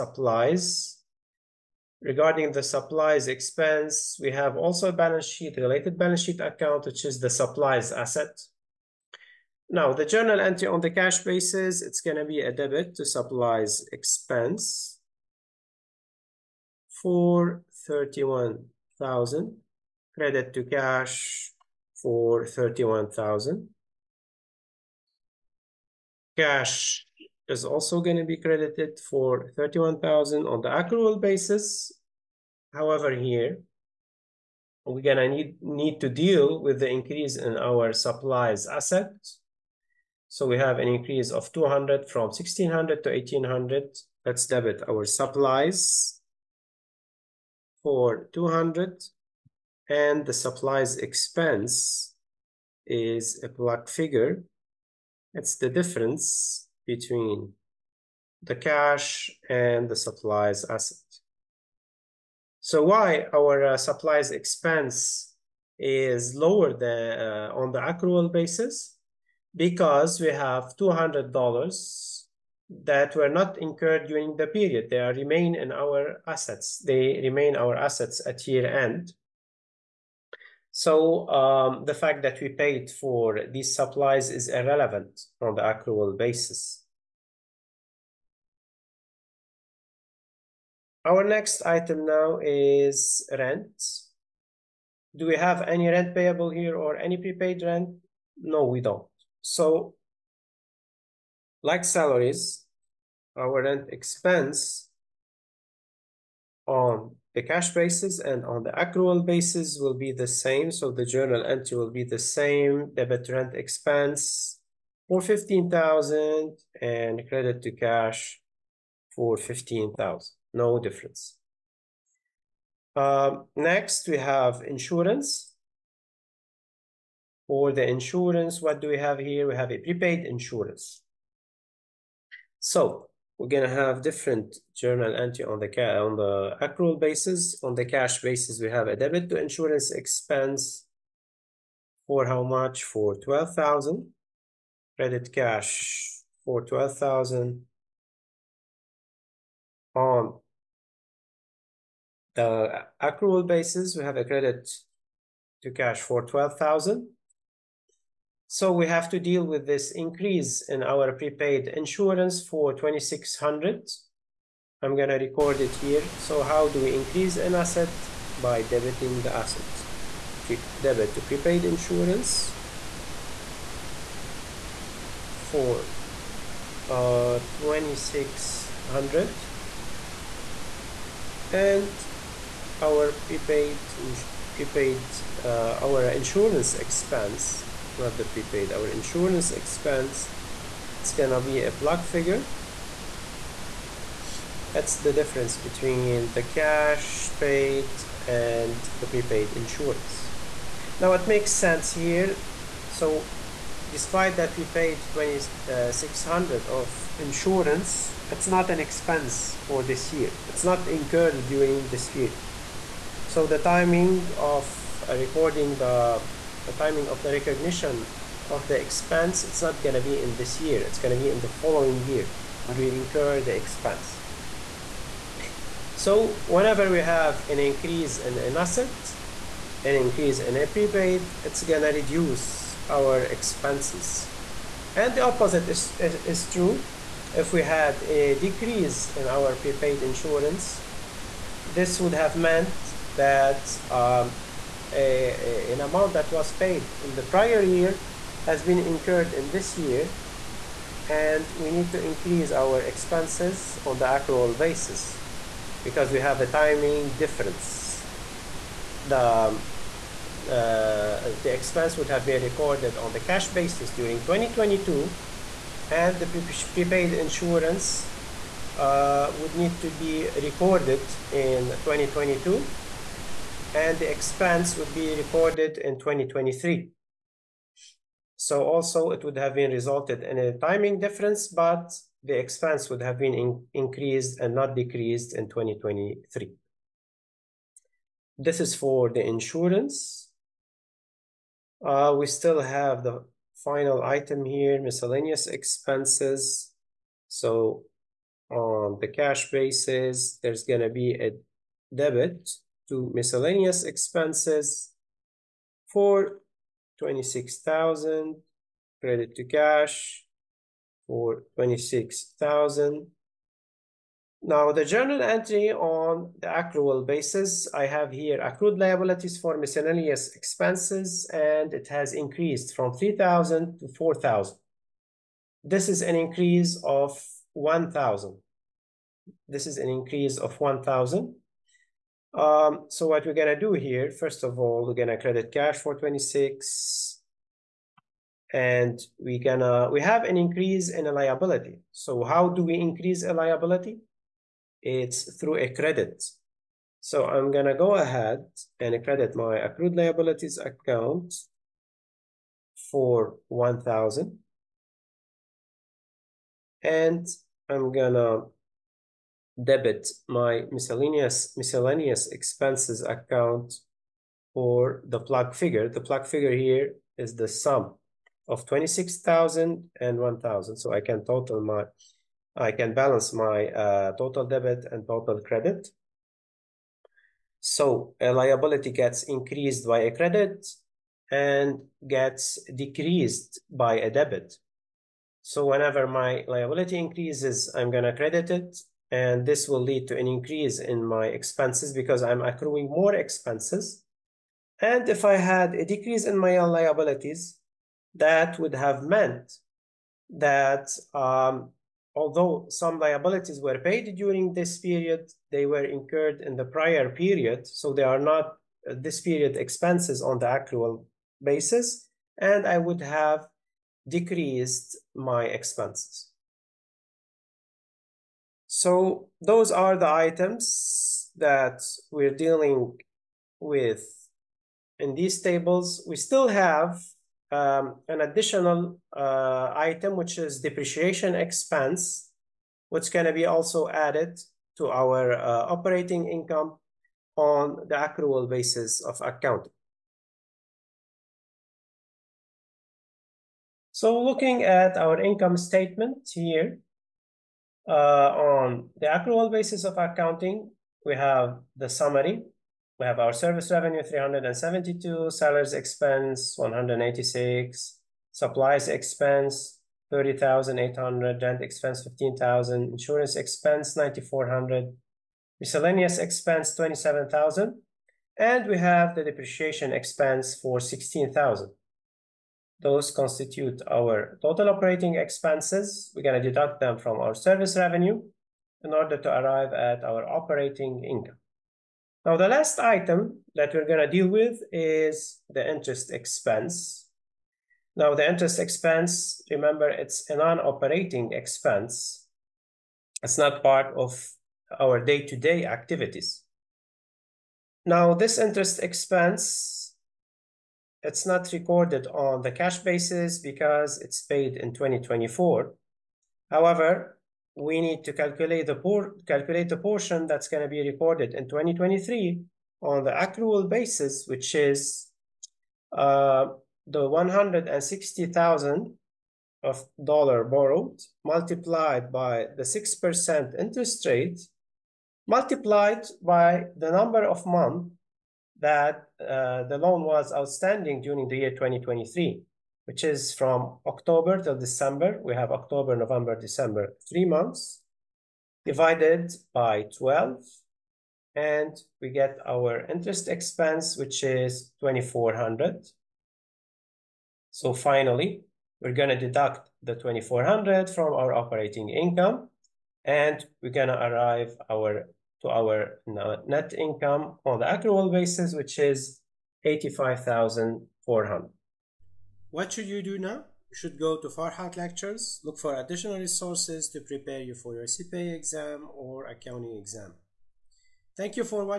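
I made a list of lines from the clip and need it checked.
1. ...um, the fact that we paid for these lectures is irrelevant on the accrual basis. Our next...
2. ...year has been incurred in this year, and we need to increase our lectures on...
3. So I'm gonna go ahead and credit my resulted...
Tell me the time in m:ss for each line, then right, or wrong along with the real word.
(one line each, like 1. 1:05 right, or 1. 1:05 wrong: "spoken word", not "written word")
1. 1:21 wrong: "supplies", not "lectures"
2. 4:07 wrong: "expenses", not "lectures"
3. 5:47 wrong: "accrued", not "resulted".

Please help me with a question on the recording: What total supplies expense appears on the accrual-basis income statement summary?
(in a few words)
30,800.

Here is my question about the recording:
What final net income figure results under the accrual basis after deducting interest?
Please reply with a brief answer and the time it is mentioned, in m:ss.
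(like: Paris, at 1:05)
85,400, at 9:19.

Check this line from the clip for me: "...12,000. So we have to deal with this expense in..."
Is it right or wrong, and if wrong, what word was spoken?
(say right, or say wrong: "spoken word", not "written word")
wrong: "increase", not "expense".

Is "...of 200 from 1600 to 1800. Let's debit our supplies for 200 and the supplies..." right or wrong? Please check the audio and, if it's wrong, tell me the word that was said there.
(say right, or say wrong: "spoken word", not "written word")
right.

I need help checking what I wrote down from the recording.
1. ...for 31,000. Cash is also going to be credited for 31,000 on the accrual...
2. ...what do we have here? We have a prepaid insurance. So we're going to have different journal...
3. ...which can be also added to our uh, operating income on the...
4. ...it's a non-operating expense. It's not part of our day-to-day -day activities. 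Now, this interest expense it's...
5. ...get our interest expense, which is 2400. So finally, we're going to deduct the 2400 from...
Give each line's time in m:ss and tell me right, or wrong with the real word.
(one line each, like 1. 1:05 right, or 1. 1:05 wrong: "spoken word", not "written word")
1. 0:21 right
2. 2:08 right
3. 7:12 right
4. 8:09 right
5. 9:02 right.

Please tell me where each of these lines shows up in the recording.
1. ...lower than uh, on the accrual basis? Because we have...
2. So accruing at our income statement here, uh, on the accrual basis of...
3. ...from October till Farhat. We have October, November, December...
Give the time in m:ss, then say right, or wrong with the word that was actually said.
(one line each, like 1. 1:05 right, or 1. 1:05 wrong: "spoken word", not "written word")
1. 1:06 right
2. 7:23 wrong: "looking", not "accruing"
3. 8:53 wrong: "December", not "Farhat".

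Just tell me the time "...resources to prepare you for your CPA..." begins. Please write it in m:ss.
9:26.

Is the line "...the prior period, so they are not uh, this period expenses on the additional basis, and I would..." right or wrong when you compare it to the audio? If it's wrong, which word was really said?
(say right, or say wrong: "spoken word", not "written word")
wrong: "accrual", not "additional".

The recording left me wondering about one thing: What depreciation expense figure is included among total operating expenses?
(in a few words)
16,000.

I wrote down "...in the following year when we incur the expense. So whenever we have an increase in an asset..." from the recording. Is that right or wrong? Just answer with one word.
right.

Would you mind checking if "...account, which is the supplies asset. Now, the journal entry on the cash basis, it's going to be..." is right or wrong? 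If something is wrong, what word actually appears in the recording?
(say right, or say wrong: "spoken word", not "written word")
right.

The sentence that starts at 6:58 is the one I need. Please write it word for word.
So those are the items that we're dealing with in these tables.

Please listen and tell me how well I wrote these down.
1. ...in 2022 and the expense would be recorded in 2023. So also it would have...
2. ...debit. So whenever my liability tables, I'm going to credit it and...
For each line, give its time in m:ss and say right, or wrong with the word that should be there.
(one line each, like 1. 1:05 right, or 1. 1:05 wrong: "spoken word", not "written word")
1. 4:31 right
2. 6:24 wrong: "increases", not "tables".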